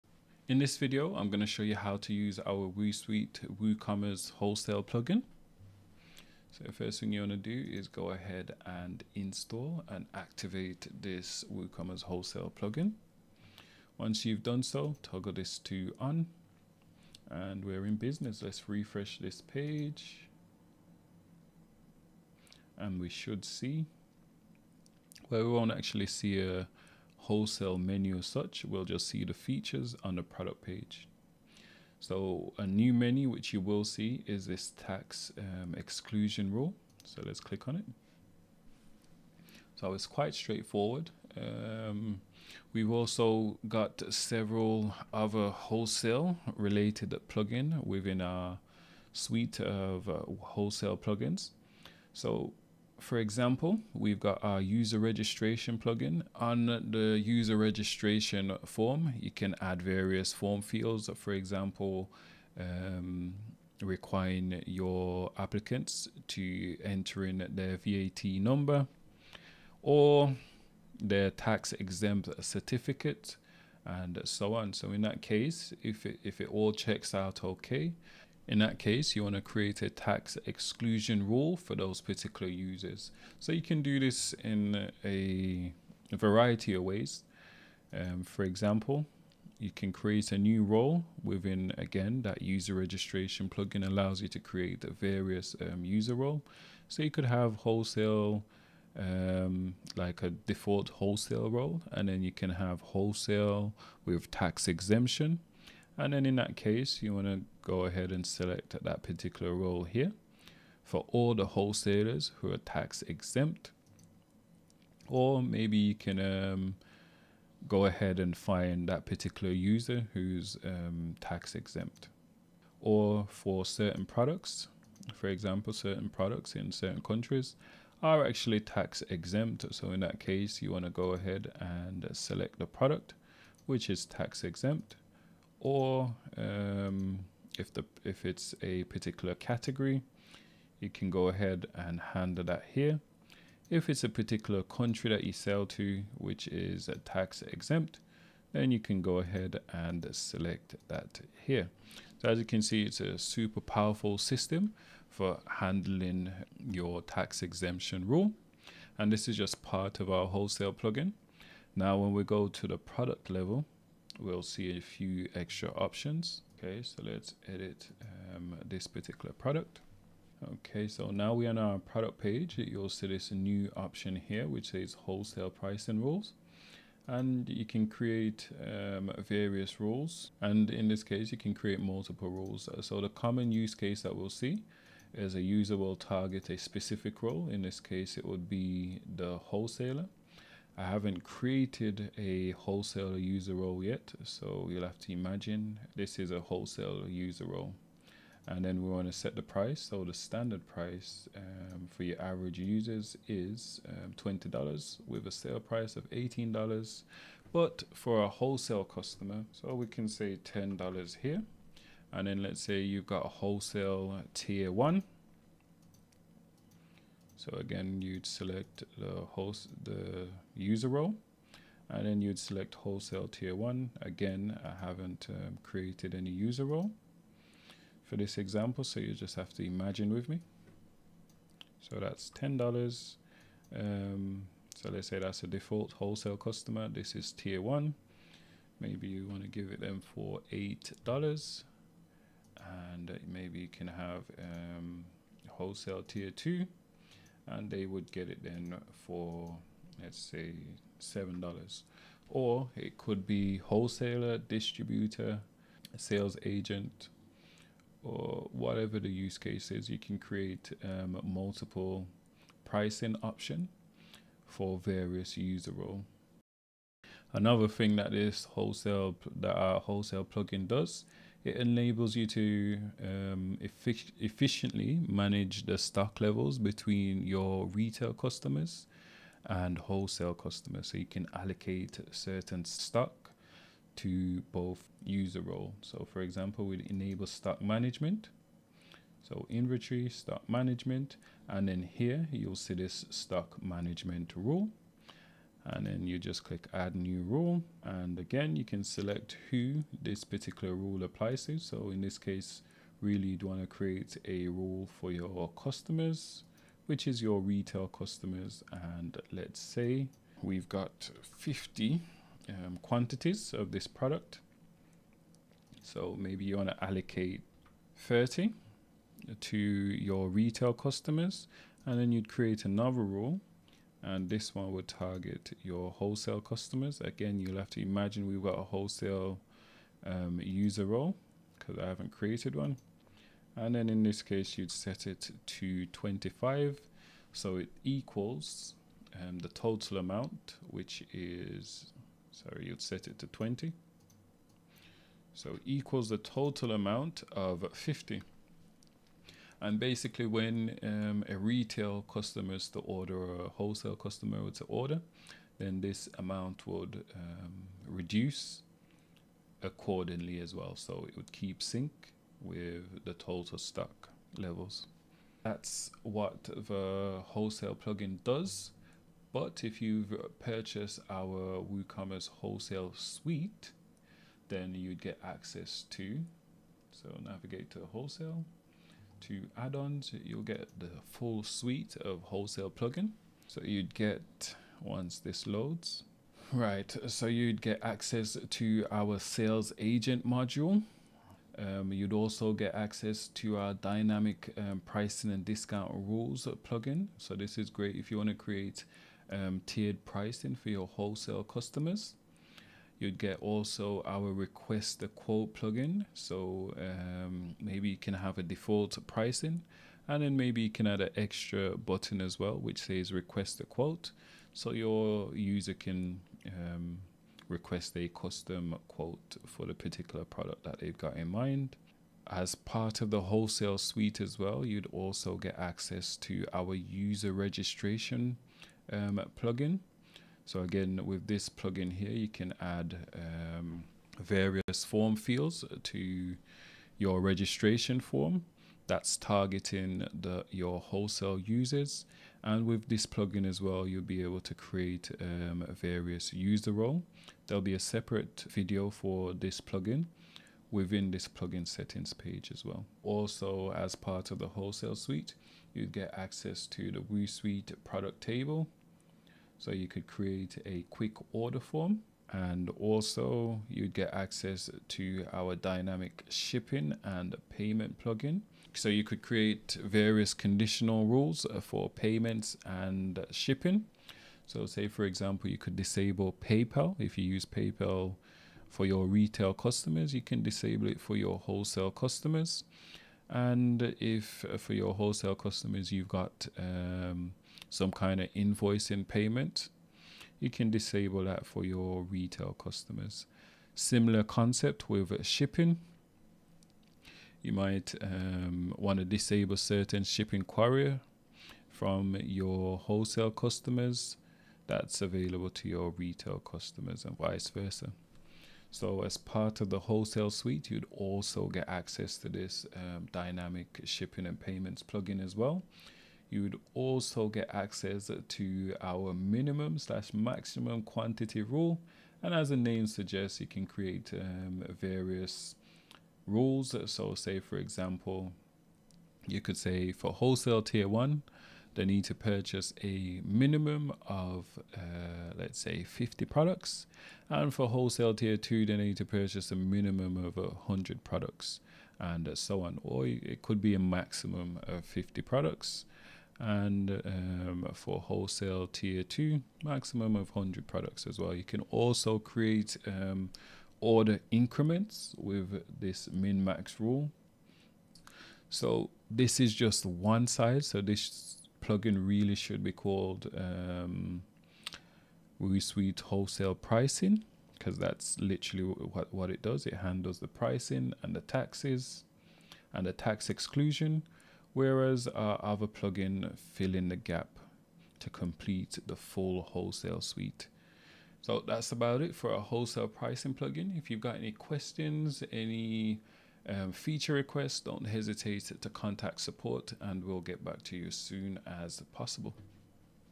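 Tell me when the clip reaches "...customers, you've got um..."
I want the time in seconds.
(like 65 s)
485 s.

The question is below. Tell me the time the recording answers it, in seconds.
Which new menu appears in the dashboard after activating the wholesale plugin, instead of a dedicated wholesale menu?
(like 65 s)
34 s.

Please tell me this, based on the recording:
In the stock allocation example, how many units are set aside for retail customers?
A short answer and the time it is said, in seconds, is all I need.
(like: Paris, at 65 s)
30, at 317 s.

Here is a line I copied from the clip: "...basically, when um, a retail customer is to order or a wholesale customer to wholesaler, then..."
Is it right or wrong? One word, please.
wrong.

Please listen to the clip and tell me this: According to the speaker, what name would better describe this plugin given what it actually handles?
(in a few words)
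WooSuite wholesale pricing.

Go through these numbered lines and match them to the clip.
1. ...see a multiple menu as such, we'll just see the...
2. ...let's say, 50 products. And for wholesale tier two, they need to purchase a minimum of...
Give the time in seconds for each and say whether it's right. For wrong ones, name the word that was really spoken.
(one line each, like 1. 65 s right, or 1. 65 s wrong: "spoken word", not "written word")
1. 26 s wrong: "wholesale", not "multiple"
2. 535 s right.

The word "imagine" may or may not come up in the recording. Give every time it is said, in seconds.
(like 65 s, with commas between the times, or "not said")
195 s, 229 s, 327 s.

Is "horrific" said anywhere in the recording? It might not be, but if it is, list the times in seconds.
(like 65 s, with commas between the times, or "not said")
not said.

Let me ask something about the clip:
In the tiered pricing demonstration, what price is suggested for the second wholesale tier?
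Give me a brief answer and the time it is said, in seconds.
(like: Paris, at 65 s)
$7, at 250 s.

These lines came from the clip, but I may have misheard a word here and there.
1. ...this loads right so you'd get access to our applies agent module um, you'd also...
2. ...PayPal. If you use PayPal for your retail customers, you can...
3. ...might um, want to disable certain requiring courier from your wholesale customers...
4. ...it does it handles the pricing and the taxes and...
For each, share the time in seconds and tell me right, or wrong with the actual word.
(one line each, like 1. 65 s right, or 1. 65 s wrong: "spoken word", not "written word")
1. 385 s wrong: "sales", not "applies"
2. 476 s right
3. 497 s wrong: "shipping", not "requiring"
4. 569 s right.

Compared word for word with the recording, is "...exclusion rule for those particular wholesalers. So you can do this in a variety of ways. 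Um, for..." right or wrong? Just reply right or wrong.
wrong.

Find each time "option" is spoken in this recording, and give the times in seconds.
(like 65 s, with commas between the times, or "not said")
165 s, 173 s, 263 s.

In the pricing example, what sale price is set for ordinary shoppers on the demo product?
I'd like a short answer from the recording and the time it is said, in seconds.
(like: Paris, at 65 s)
$18, at 206 s.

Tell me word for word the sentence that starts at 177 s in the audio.
And you can create um, various rules.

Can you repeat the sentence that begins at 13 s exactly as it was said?
Once you've done so, toggle this to on and we're in business.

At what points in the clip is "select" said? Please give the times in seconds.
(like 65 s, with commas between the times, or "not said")
108 s, 132 s, 150 s, 218 s, 222 s, 298 s.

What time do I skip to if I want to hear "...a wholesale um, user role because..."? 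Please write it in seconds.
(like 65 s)
328 s.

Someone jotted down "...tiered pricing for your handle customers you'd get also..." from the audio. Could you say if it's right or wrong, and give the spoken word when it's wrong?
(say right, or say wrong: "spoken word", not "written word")
wrong: "wholesale", not "handle".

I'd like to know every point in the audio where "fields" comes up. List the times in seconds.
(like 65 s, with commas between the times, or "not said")
60 s, 435 s.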